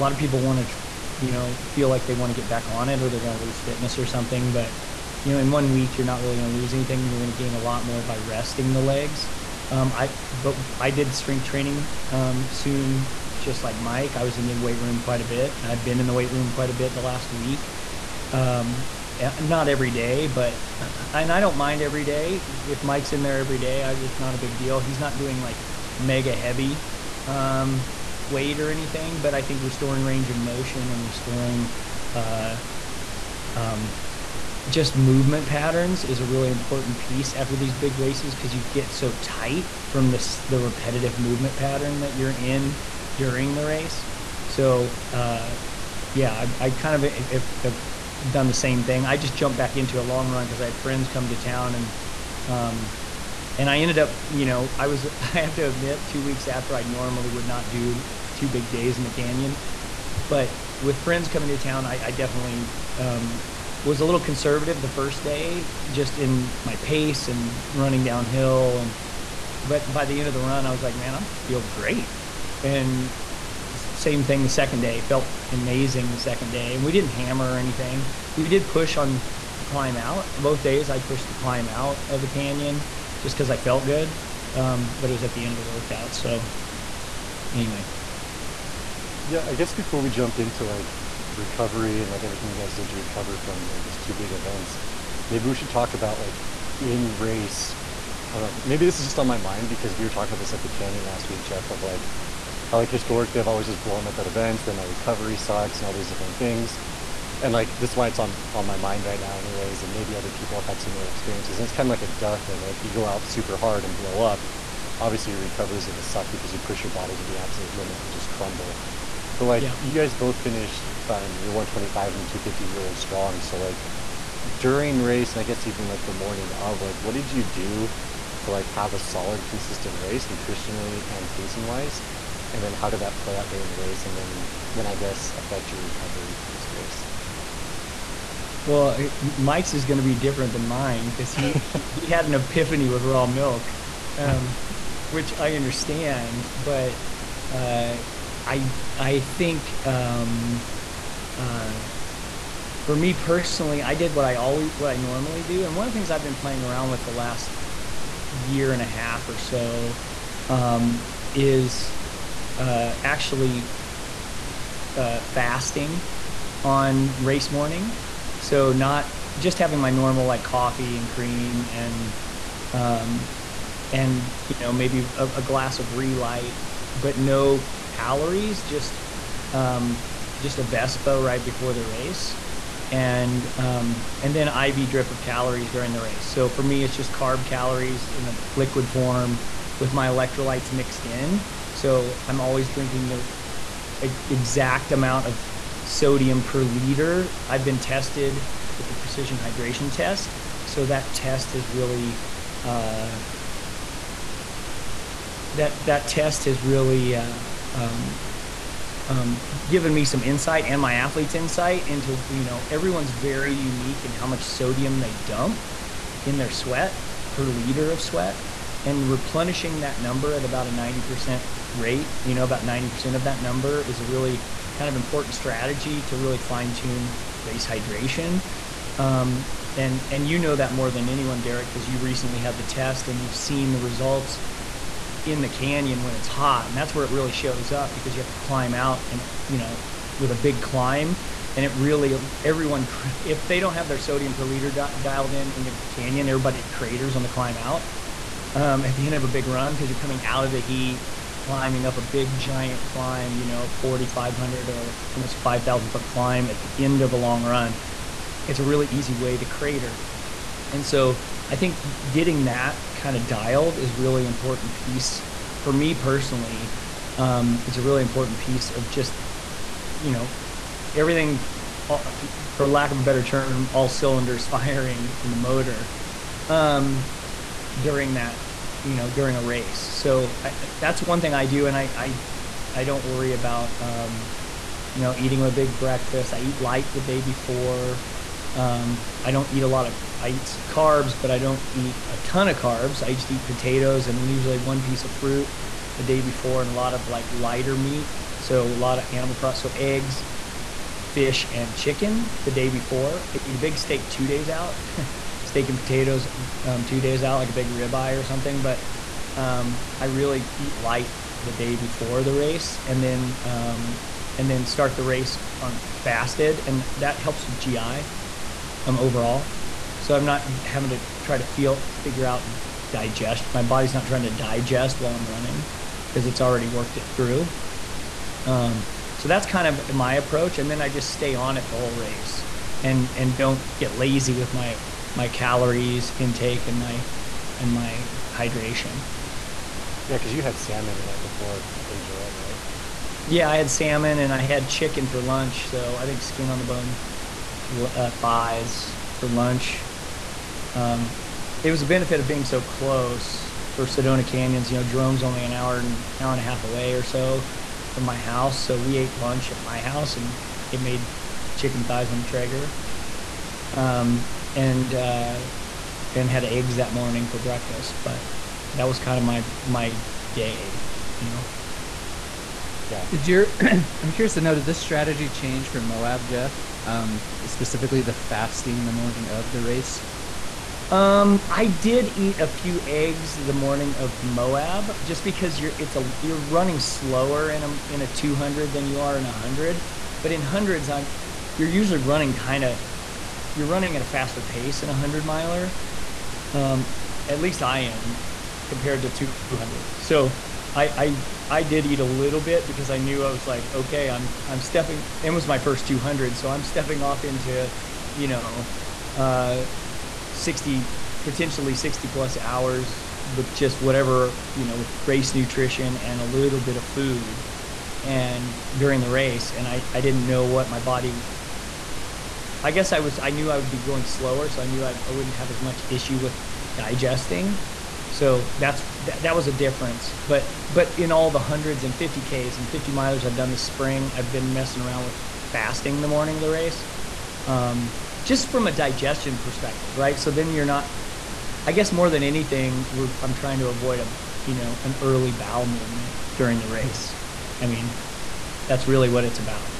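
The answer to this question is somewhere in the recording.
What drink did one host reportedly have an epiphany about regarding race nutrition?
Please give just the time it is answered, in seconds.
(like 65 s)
143 s.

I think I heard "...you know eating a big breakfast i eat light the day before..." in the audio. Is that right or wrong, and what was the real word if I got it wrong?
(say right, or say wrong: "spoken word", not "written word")
right.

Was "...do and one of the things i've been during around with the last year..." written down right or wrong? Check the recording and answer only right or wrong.
wrong.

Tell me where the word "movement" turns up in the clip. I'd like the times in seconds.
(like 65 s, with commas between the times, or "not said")
34 s, 41 s, 445 s.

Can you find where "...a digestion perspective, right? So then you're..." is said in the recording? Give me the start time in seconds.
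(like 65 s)
438 s.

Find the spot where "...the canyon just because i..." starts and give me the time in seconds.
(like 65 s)
82 s.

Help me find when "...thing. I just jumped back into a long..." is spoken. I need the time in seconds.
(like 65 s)
48 s.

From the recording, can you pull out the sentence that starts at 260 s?
And so I think getting that kind of dialed is really important piece for me personally.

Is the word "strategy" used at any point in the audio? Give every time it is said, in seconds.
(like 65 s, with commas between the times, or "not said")
225 s, 374 s.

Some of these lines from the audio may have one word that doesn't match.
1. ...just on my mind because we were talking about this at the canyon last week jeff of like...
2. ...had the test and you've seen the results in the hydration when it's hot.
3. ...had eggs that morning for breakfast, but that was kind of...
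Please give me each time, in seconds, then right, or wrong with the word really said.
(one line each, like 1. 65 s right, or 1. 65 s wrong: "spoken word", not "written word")
1. 99 s right
2. 232 s wrong: "canyon", not "hydration"
3. 366 s right.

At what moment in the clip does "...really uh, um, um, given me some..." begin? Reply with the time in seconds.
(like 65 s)
206 s.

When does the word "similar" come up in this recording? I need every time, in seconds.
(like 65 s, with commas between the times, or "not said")
110 s.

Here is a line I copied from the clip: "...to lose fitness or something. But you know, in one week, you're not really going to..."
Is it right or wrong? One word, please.
right.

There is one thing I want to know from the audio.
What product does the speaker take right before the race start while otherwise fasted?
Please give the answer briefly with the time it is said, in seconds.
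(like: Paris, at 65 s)
Vespa, at 180 s.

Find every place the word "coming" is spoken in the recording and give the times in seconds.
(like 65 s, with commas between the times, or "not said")
61 s, 249 s.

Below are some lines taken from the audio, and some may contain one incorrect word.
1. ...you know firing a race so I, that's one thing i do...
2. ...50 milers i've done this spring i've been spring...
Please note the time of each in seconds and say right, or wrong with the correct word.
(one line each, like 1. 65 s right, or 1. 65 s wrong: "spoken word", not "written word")
1. 278 s wrong: "during", not "firing"
2. 432 s wrong: "messing", not "spring".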